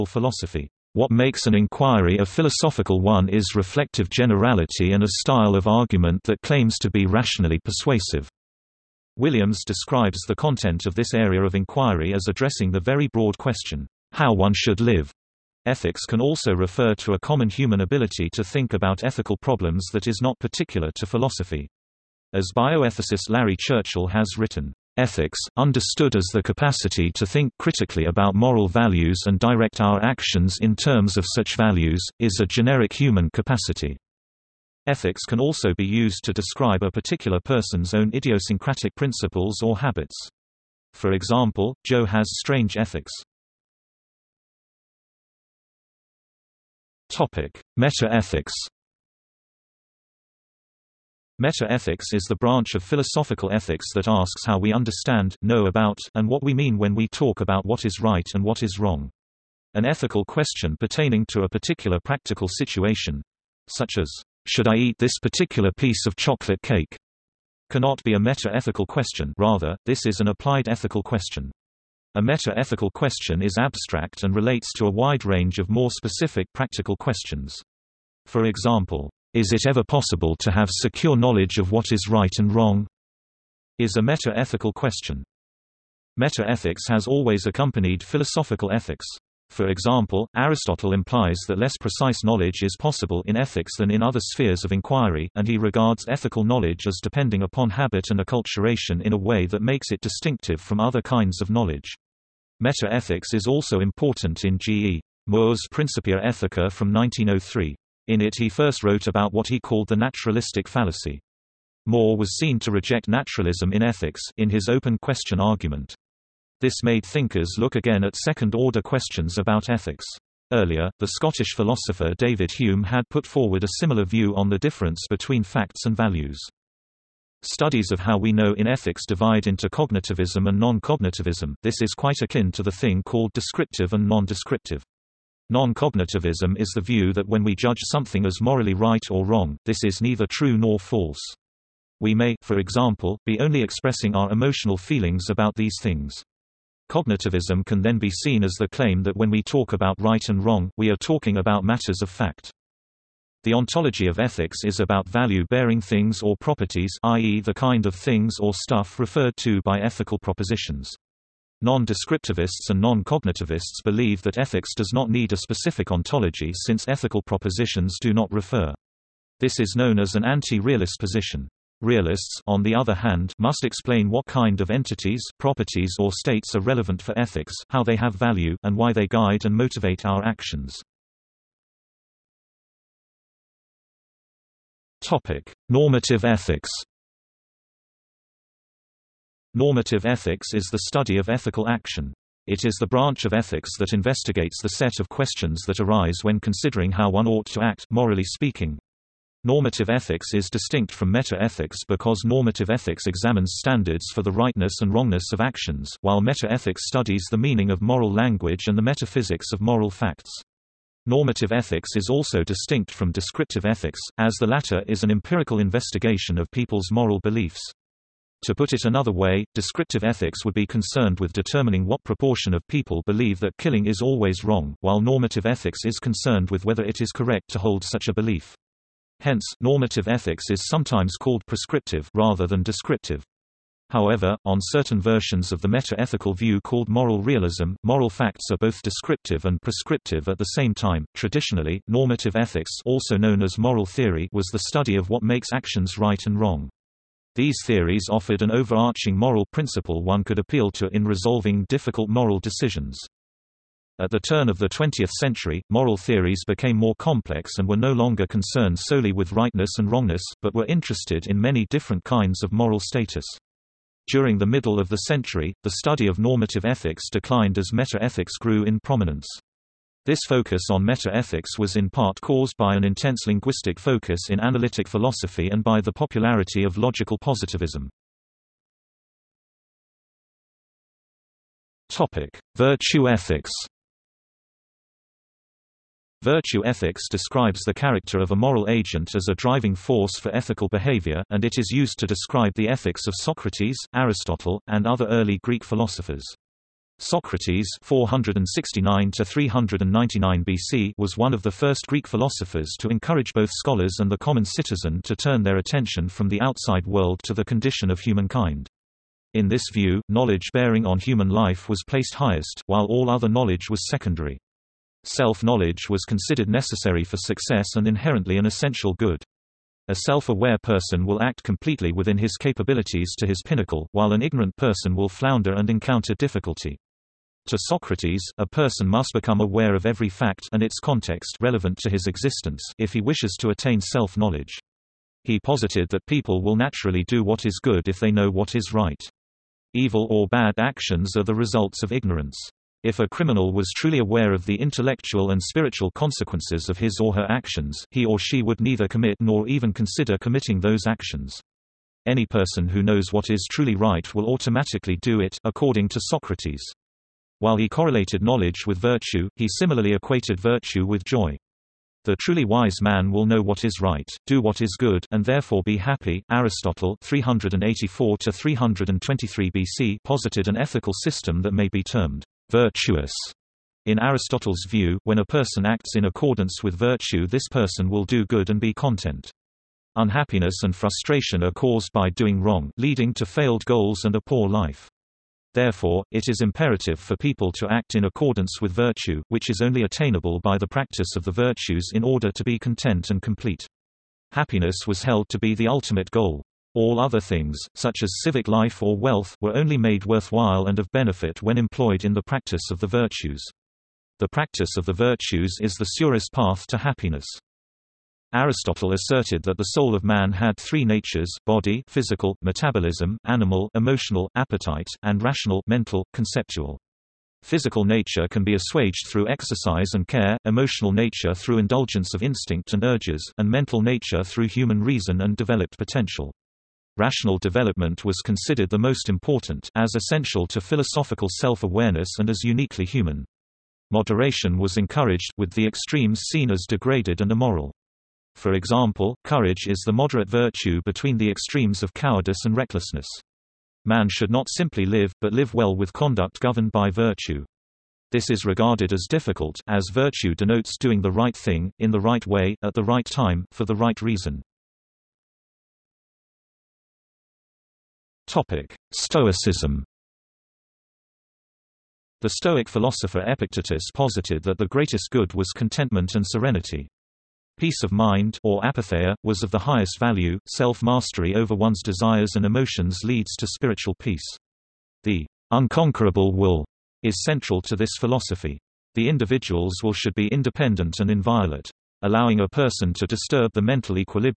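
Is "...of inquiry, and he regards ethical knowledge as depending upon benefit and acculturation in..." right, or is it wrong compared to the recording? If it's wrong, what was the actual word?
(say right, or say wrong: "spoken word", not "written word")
wrong: "habit", not "benefit".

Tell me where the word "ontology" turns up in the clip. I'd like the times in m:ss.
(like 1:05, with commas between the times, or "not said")
2:33, 2:45.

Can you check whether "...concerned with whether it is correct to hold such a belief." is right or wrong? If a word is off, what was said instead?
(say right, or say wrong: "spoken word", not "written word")
right.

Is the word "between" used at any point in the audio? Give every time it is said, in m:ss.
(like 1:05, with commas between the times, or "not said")
2:05, 7:20.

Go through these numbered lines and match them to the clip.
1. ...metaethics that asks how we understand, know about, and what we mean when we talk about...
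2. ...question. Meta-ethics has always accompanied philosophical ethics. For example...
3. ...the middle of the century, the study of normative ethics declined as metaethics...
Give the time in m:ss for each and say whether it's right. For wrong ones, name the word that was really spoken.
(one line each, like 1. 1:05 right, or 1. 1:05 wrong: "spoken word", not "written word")
1. 0:53 wrong: "ethics", not "metaethics"
2. 1:24 right
3. 4:24 right.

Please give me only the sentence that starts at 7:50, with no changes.
Self mastery over one's desires and emotions leads to spiritual peace.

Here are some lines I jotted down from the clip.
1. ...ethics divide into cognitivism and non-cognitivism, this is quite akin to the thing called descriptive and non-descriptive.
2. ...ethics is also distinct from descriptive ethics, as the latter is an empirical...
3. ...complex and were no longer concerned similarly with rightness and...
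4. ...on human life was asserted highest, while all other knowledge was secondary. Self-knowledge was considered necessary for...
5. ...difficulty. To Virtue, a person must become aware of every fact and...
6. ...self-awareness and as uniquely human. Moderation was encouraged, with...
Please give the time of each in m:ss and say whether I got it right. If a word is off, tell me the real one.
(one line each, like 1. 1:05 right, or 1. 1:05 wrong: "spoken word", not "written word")
1. 2:08 right
2. 3:31 right
3. 4:16 wrong: "solely", not "similarly"
4. 5:10 wrong: "placed", not "asserted"
5. 5:26 wrong: "Socrates", not "Virtue"
6. 7:11 right.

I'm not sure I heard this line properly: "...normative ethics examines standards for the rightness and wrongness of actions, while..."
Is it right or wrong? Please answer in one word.
right.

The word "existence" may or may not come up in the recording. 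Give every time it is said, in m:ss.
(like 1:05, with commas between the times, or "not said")
5:32.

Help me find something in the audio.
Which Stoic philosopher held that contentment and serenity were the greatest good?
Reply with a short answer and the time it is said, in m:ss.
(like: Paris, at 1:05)
Epictetus, at 7:43.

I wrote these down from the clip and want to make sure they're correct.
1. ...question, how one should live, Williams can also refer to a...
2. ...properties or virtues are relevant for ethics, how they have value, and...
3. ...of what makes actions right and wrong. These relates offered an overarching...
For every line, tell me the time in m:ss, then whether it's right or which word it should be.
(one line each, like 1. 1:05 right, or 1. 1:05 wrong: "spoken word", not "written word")
1. 0:13 wrong: "Ethics", not "Williams"
2. 2:55 wrong: "states", not "virtues"
3. 4:04 wrong: "theories", not "relates".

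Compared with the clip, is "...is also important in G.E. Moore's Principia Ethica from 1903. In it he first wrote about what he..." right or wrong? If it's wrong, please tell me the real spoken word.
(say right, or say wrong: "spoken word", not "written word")
right.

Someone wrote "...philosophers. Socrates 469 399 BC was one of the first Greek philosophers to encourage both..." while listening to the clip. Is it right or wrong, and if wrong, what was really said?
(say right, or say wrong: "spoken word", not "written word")
right.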